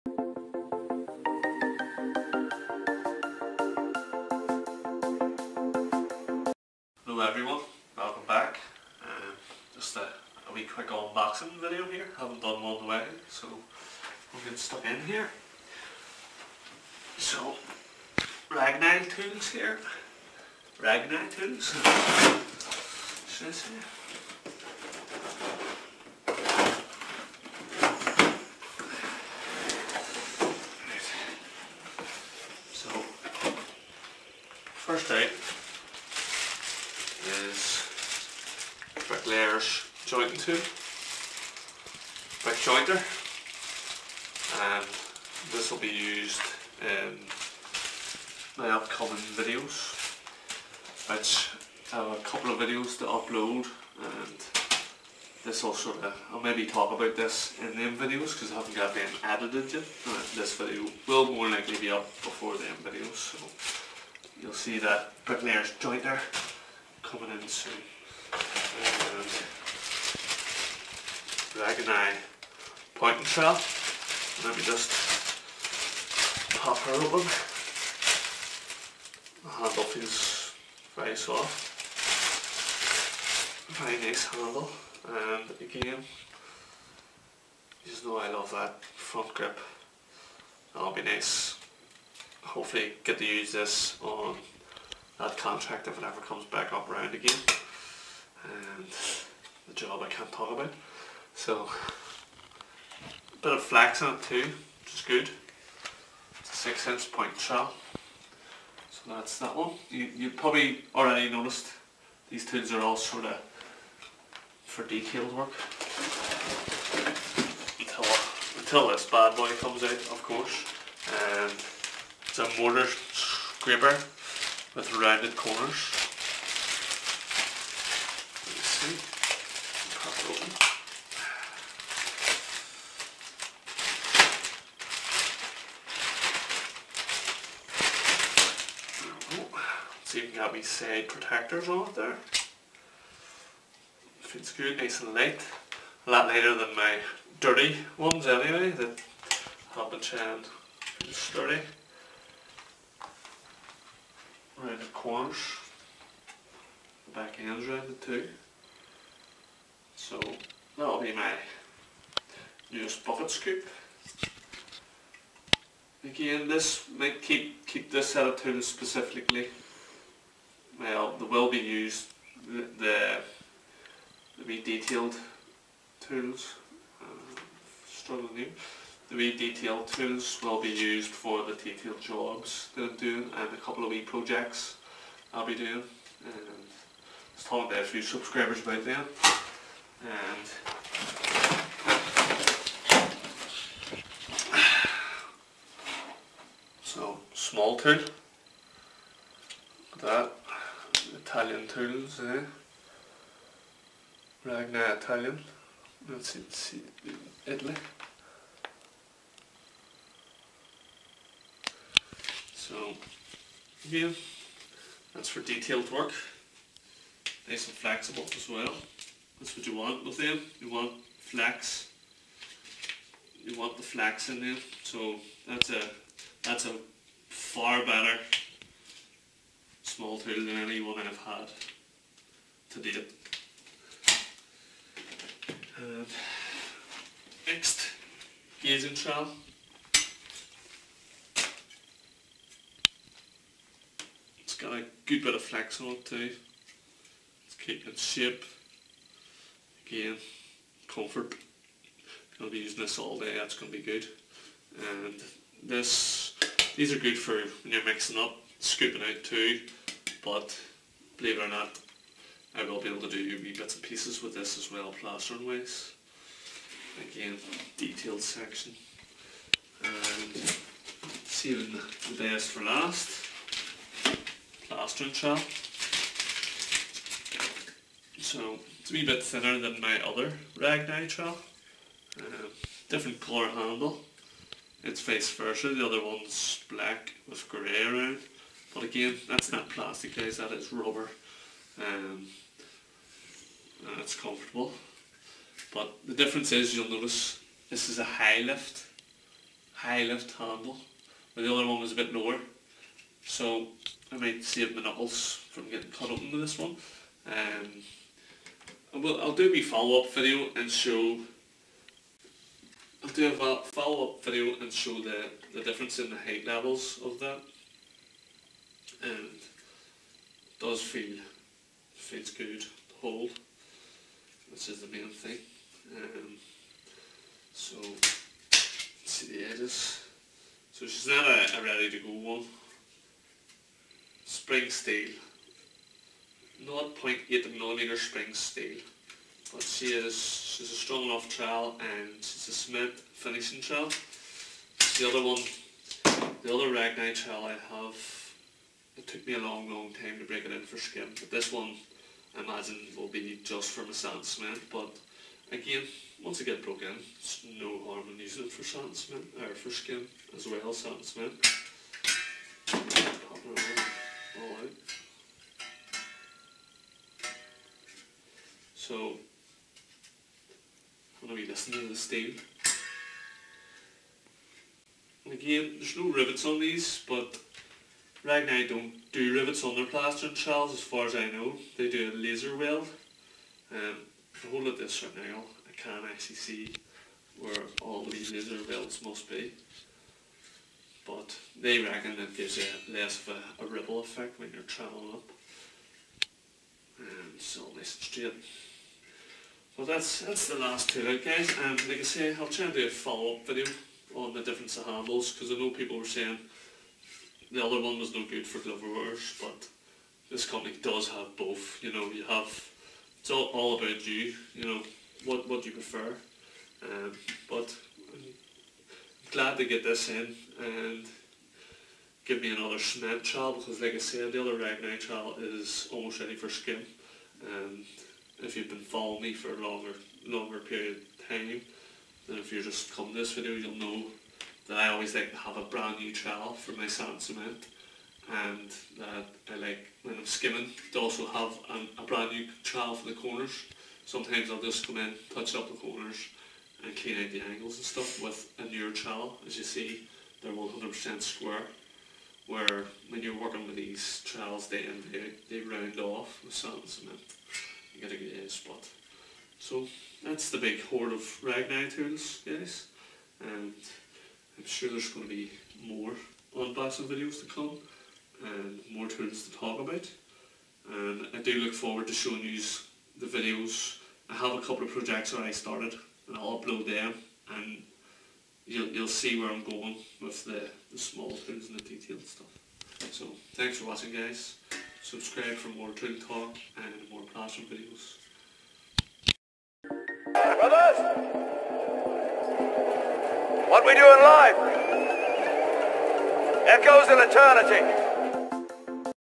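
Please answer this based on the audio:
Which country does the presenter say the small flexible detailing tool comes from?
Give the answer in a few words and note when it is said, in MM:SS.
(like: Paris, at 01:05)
Italy, at 03:27.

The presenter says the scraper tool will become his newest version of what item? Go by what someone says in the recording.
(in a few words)
Bucket scoop.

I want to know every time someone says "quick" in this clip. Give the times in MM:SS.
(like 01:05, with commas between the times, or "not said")
00:10, 00:42.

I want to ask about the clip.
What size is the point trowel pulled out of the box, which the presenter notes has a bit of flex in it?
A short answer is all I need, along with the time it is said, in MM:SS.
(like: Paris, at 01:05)
6 inch, at 01:46.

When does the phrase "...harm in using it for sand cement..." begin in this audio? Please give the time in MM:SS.
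05:57.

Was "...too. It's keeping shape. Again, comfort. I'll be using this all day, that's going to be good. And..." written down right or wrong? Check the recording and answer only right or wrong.
right.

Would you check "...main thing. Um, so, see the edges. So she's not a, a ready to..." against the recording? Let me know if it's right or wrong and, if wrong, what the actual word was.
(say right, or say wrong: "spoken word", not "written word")
right.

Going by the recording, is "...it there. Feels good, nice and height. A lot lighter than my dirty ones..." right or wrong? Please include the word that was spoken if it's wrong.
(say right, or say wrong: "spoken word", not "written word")
wrong: "light", not "height".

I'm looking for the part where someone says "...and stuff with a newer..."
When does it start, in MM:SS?
07:27.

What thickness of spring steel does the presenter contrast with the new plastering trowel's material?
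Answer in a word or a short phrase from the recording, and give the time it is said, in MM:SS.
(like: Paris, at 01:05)
0.8 millimeter, at 05:36.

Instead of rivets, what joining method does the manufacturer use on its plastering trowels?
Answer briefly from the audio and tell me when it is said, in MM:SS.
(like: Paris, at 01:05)
Laser weld, at 06:22.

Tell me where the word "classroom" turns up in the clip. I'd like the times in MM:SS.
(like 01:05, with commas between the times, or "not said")
08:07.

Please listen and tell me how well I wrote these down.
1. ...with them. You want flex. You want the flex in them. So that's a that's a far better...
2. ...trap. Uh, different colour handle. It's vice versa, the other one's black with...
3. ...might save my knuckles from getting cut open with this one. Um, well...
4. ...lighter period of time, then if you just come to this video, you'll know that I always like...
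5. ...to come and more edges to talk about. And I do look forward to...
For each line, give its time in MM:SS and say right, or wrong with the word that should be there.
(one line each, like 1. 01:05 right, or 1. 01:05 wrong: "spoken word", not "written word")
1. 03:40 right
2. 04:41 right
3. 05:04 right
4. 07:10 wrong: "longer", not "lighter"
5. 07:47 wrong: "tunes", not "edges".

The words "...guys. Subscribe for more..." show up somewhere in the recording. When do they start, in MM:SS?
08:04.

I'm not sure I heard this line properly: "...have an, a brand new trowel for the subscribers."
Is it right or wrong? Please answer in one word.
wrong.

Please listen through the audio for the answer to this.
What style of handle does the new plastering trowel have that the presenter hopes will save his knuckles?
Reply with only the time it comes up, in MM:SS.
04:59.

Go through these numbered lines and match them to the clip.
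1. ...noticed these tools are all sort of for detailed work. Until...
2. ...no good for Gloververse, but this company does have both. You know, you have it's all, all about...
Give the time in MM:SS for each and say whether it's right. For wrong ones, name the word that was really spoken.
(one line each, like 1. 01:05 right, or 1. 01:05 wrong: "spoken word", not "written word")
1. 01:51 right
2. 06:48 right.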